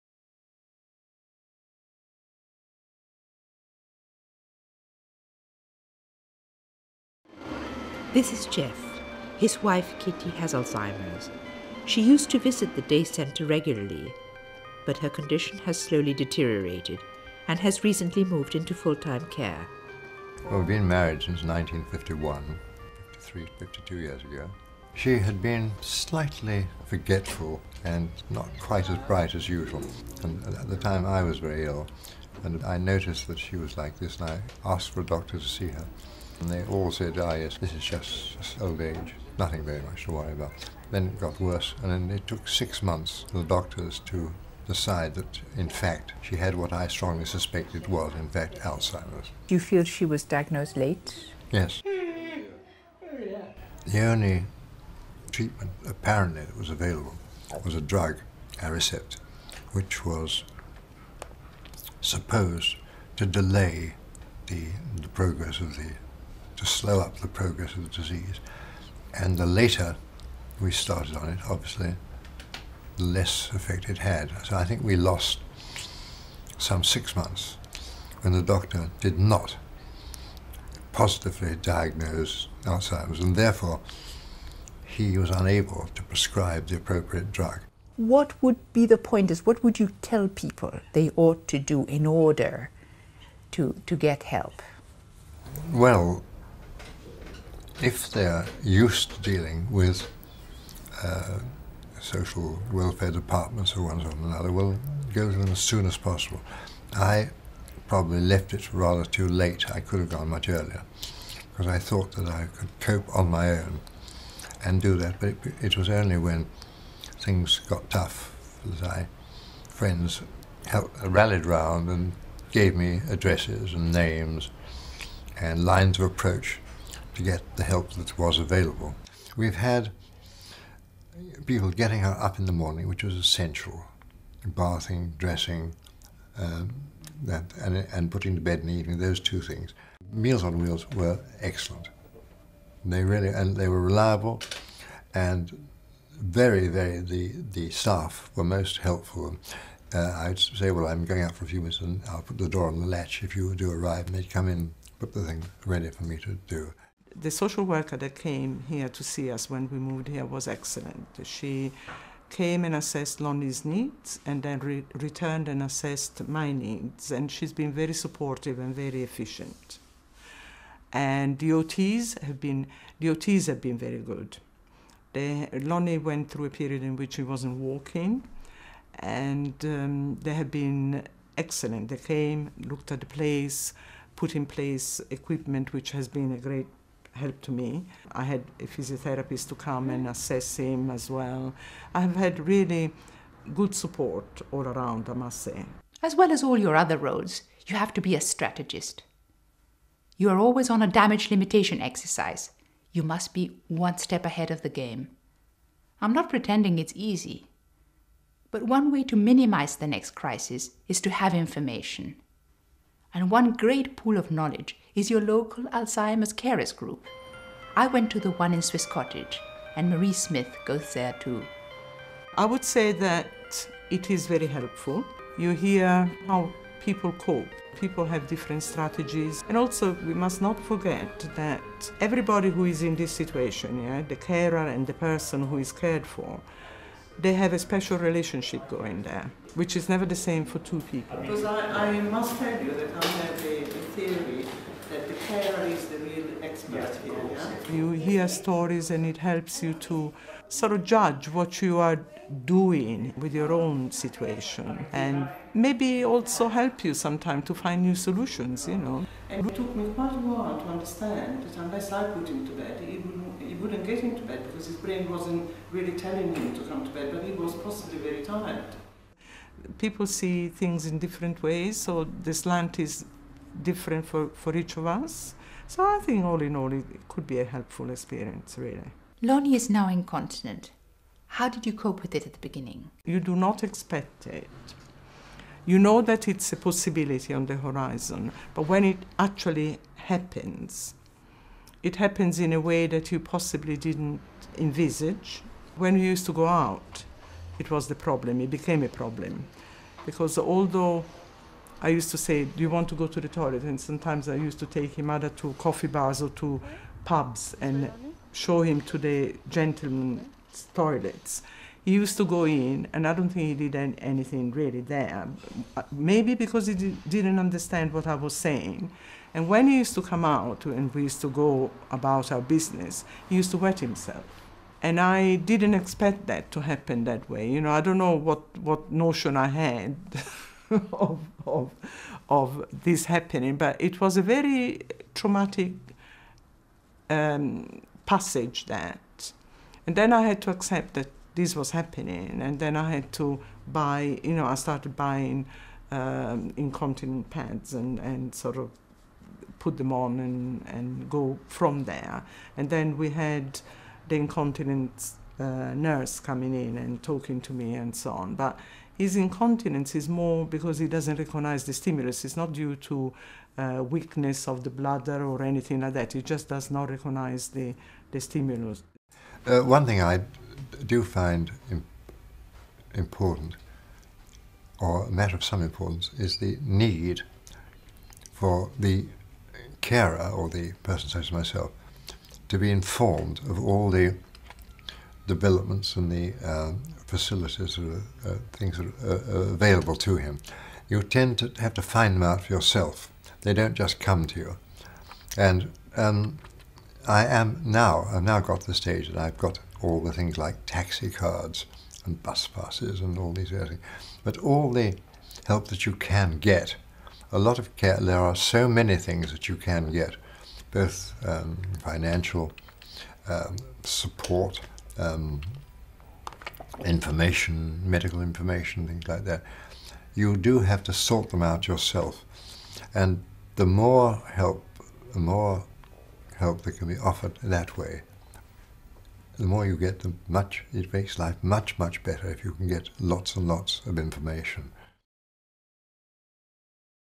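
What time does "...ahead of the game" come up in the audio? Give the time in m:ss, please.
3:24.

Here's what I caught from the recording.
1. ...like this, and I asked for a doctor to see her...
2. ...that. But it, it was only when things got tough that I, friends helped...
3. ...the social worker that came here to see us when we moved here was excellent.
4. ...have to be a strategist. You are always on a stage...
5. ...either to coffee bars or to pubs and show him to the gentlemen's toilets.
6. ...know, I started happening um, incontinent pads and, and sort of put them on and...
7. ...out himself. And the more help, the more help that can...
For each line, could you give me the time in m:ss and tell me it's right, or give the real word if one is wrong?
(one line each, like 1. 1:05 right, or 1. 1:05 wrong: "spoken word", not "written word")
1. 0:33 right
2. 1:54 right
3. 2:37 right
4. 3:17 wrong: "damage", not "stage"
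5. 5:05 right
6. 5:44 wrong: "buying", not "happening"
7. 7:01 wrong: "yourself", not "himself".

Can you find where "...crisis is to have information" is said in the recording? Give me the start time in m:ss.
3:30.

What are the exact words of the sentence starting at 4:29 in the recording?
People see things in different ways, so the slant is different for, for each of us.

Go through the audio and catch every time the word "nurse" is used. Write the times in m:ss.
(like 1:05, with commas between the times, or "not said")
5:55.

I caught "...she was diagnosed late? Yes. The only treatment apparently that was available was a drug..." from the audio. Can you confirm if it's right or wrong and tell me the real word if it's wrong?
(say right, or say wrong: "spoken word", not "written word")
right.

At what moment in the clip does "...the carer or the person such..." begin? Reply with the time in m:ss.
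6:18.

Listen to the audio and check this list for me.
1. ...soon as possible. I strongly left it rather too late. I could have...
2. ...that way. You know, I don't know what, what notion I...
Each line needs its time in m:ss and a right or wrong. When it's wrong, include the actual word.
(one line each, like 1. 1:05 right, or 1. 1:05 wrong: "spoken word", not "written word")
1. 1:45 wrong: "probably", not "strongly"
2. 5:27 right.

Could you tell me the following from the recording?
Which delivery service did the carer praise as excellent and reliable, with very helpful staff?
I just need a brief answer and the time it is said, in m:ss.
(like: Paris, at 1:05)
Meals on Wheels, at 2:20.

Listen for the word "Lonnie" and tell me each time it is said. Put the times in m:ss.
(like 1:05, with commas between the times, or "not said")
2:43, 2:55, 4:39.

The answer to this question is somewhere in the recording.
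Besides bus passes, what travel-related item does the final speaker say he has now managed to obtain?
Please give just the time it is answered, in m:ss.
6:40.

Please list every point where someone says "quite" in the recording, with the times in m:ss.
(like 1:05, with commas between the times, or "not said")
0:28, 4:19.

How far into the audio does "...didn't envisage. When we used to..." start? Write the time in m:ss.
4:53.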